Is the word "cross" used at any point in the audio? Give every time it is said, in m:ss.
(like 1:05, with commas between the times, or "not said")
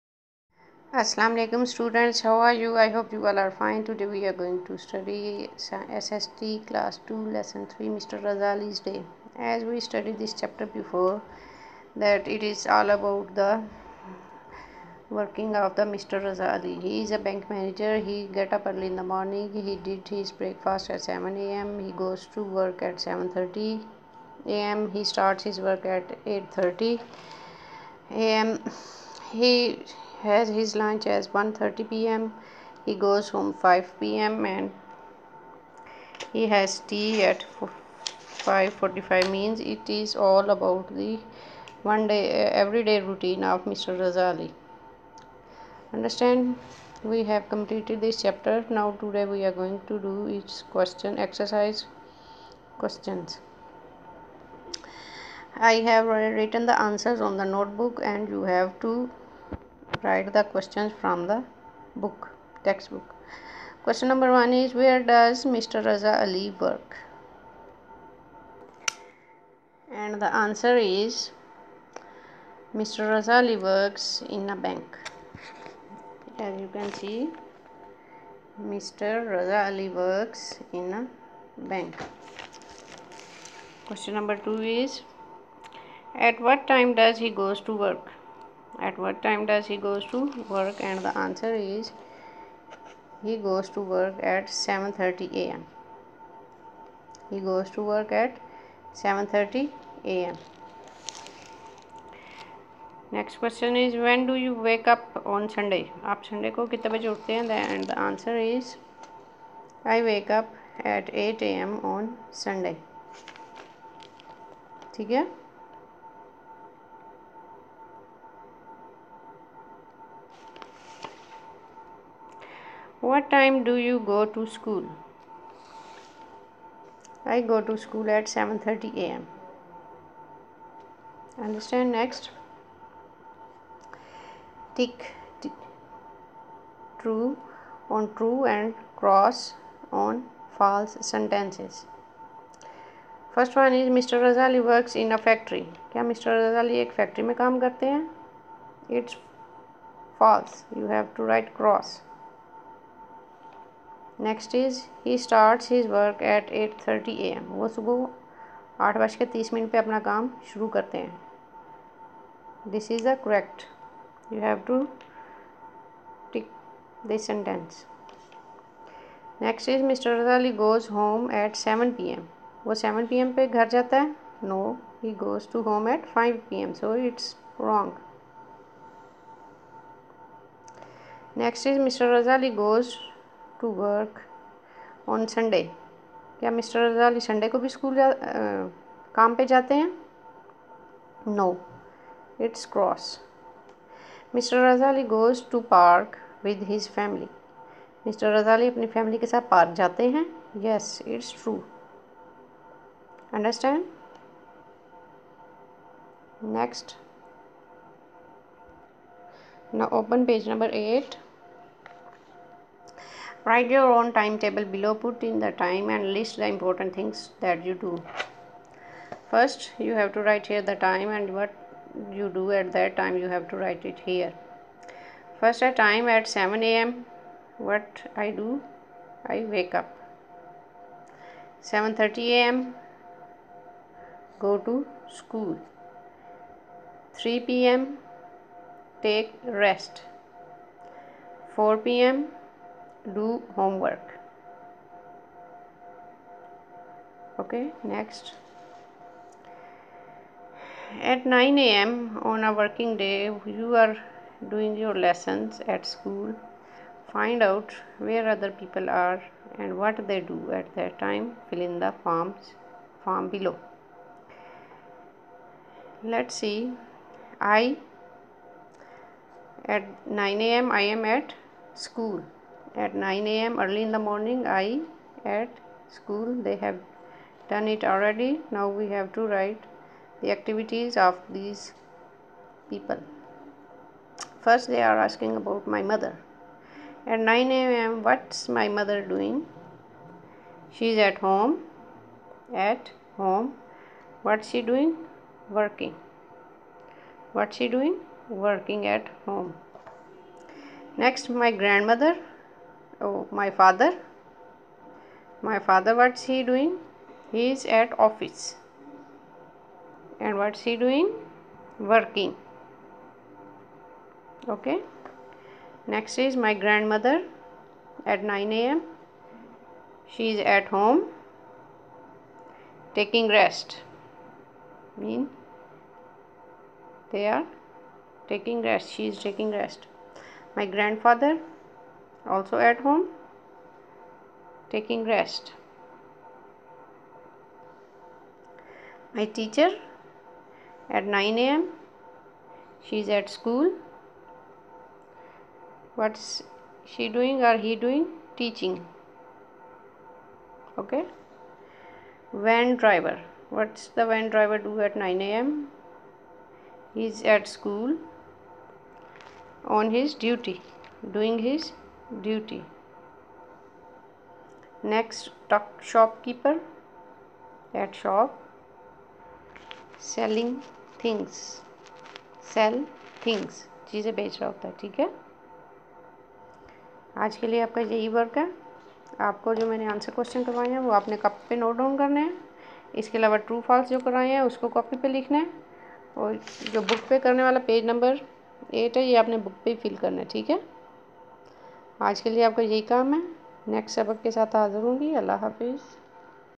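2:19, 2:31.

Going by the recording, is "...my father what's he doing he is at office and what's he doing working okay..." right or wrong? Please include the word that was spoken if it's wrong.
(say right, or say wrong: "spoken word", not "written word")
right.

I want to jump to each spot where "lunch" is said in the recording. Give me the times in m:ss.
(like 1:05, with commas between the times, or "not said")
0:30.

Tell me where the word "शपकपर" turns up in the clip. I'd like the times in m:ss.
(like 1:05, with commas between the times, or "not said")
6:05.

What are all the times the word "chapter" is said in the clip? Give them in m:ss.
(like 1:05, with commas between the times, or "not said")
0:10, 0:48.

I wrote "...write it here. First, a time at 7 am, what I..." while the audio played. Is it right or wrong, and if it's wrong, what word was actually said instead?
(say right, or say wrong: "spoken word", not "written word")
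right.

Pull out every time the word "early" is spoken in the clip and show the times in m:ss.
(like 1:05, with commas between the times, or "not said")
0:18, 4:33.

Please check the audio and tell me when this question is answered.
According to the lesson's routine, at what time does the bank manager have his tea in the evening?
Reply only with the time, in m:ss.
0:37.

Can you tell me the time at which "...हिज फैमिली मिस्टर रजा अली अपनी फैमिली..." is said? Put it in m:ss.
3:16.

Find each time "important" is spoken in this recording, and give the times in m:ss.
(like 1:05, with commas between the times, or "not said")
3:36.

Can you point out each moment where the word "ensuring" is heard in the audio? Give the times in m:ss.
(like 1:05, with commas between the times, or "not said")
not said.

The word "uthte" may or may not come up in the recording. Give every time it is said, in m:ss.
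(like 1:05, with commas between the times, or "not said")
1:47.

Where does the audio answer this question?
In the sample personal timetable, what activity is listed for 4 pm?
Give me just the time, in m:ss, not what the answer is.
4:03.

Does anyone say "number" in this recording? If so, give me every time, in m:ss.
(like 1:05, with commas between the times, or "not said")
1:04, 1:24.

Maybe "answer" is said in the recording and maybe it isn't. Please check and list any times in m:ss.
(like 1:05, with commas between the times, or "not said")
0:56, 1:10, 1:31, 1:48.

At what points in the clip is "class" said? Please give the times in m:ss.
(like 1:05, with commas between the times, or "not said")
0:06.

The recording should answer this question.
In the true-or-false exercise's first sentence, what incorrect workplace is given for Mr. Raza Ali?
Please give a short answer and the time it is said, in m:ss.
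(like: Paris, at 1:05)
a factory, at 2:25.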